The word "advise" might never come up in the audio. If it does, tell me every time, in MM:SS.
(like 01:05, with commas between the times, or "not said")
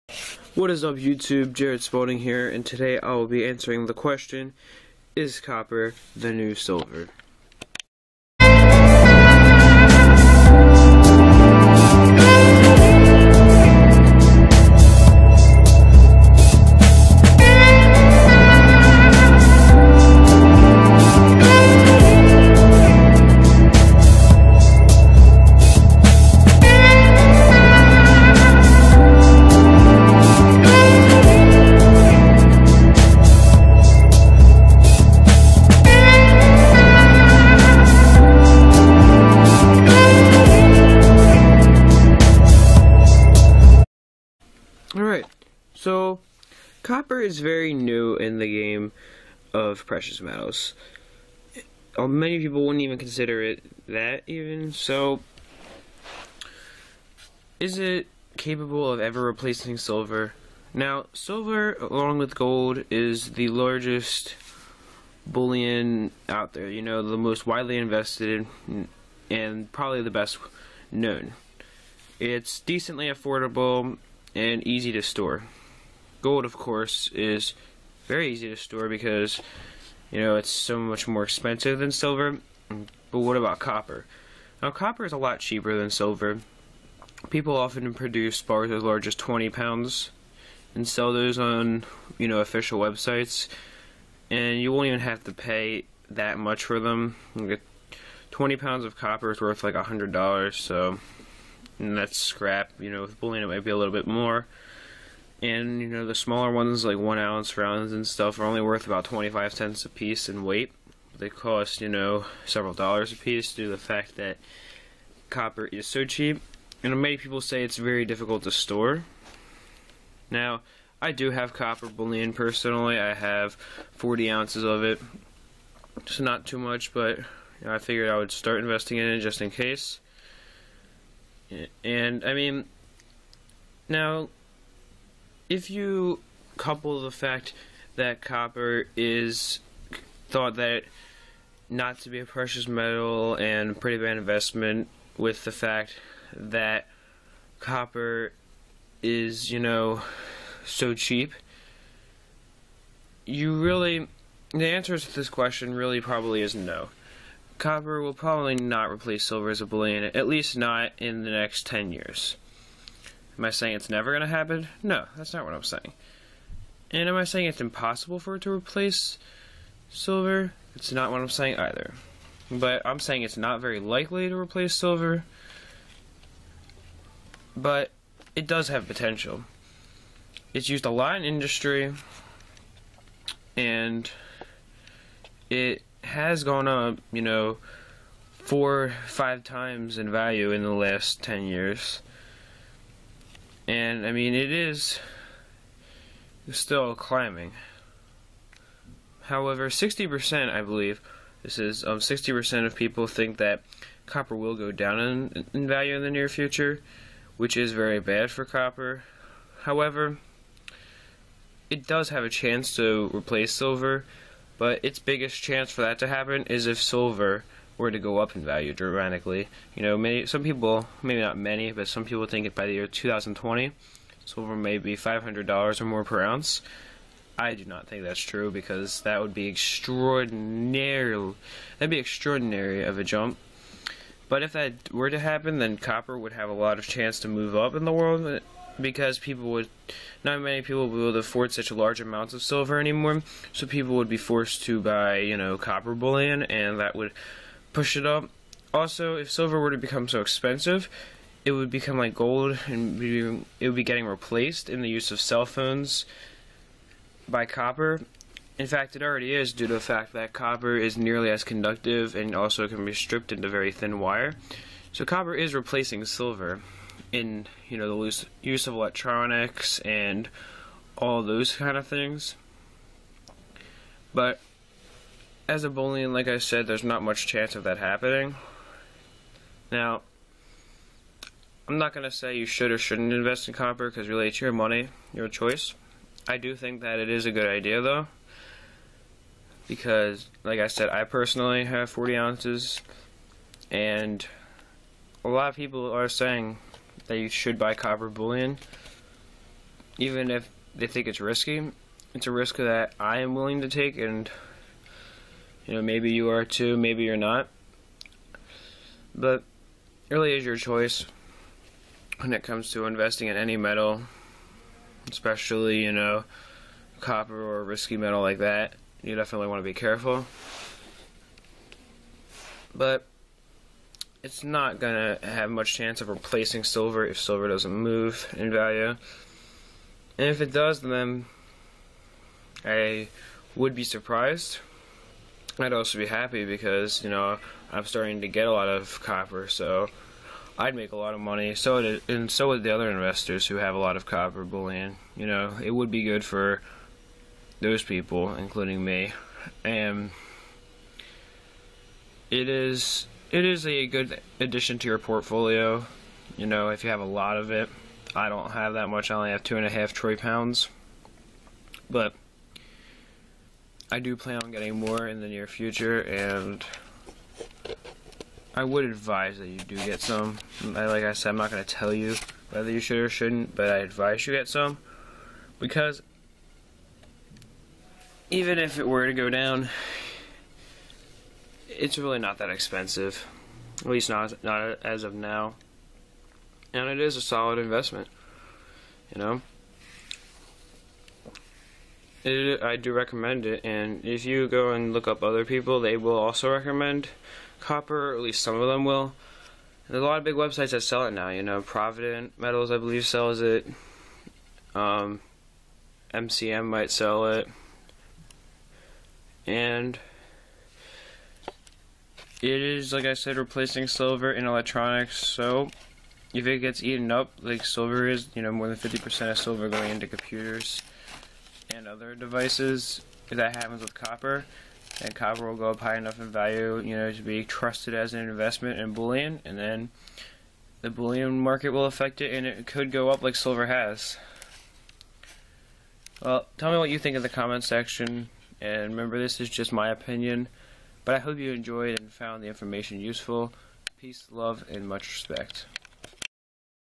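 06:08, 06:13.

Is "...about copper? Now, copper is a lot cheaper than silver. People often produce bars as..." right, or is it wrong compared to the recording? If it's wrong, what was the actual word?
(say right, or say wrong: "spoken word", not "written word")
right.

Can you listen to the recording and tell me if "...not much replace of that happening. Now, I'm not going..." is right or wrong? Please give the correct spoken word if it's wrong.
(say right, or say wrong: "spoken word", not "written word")
wrong: "chance", not "replace".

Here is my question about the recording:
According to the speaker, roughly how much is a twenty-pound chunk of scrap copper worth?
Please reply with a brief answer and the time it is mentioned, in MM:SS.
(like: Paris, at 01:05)
$100, at 01:39.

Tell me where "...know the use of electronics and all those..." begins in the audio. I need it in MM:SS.
04:27.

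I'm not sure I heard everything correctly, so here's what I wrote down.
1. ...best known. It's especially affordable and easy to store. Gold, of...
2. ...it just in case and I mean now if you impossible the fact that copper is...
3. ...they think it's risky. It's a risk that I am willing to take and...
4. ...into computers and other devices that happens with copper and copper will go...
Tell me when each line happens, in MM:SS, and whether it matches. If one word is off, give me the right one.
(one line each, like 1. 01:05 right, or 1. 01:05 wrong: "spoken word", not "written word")
1. 01:10 wrong: "decently", not "especially"
2. 02:09 wrong: "couple", not "impossible"
3. 05:00 right
4. 06:59 right.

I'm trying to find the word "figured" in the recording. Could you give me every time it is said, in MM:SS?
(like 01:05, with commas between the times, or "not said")
02:07.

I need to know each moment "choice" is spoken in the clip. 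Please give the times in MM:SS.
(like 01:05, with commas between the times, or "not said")
04:45, 05:10.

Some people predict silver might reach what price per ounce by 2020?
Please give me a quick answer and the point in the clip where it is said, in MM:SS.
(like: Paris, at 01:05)
$500, at 03:44.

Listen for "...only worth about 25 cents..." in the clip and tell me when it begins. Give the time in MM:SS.
01:48.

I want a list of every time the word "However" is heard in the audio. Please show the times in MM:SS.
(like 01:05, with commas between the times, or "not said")
03:19, 03:29.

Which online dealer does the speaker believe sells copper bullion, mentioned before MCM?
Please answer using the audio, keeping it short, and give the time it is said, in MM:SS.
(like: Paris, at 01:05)
Provident Metals, at 06:41.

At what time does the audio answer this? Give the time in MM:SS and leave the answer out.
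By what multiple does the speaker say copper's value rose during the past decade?
03:08.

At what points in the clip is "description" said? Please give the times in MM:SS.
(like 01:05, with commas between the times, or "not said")
not said.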